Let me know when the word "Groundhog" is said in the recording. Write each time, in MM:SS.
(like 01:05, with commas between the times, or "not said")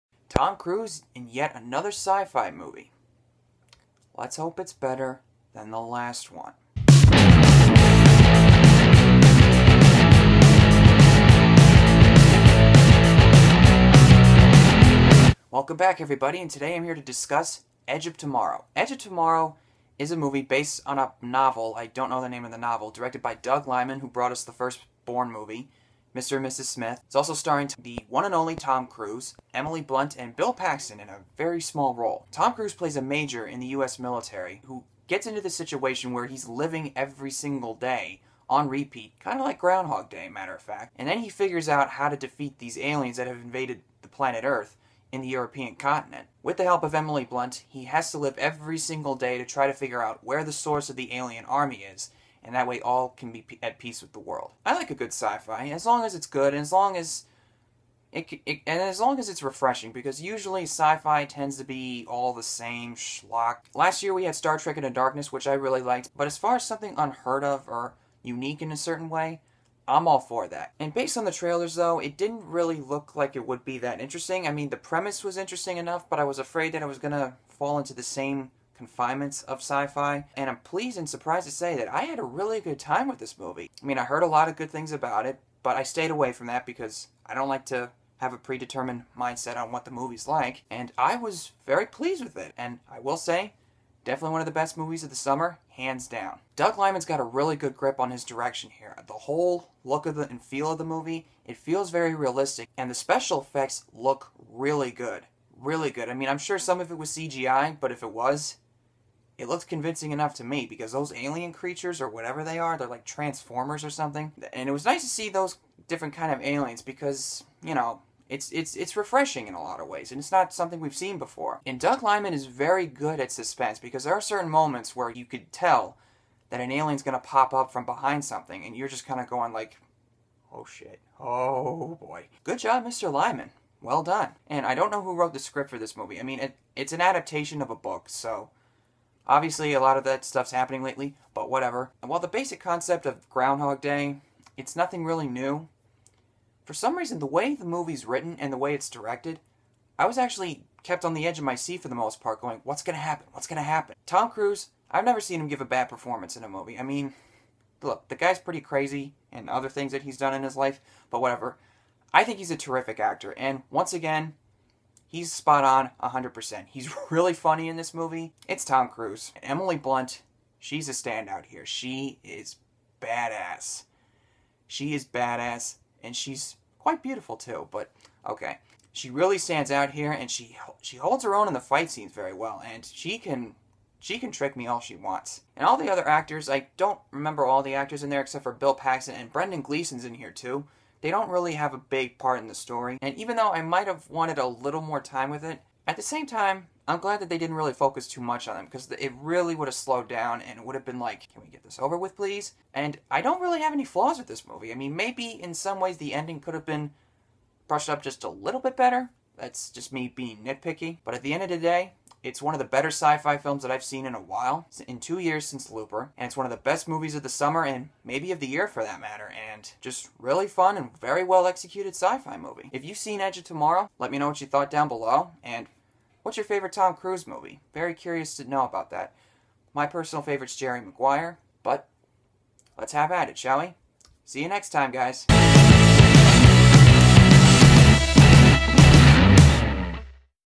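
00:39, 02:23.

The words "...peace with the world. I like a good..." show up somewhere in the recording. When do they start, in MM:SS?
00:53.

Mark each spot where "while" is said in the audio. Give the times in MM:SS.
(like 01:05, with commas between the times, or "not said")
02:22, 03:34.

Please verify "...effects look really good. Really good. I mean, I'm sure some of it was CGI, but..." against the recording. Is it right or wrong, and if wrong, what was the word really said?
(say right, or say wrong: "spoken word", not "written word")
right.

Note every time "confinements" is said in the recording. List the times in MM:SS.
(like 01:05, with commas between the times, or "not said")
01:18.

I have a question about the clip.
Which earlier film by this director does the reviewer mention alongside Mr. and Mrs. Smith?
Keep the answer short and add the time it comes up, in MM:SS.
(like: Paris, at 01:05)
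the first Bourne movie, at 00:24.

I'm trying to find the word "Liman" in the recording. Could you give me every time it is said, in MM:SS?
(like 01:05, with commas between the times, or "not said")
00:23, 01:36, 02:02, 02:13.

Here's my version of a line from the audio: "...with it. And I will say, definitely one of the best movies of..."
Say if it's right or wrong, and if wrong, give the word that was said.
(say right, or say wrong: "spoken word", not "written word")
right.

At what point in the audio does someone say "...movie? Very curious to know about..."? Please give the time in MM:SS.
03:47.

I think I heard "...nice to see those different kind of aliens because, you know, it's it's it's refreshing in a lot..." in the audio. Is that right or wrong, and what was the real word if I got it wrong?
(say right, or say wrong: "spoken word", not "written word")
right.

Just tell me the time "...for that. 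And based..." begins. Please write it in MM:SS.
01:10.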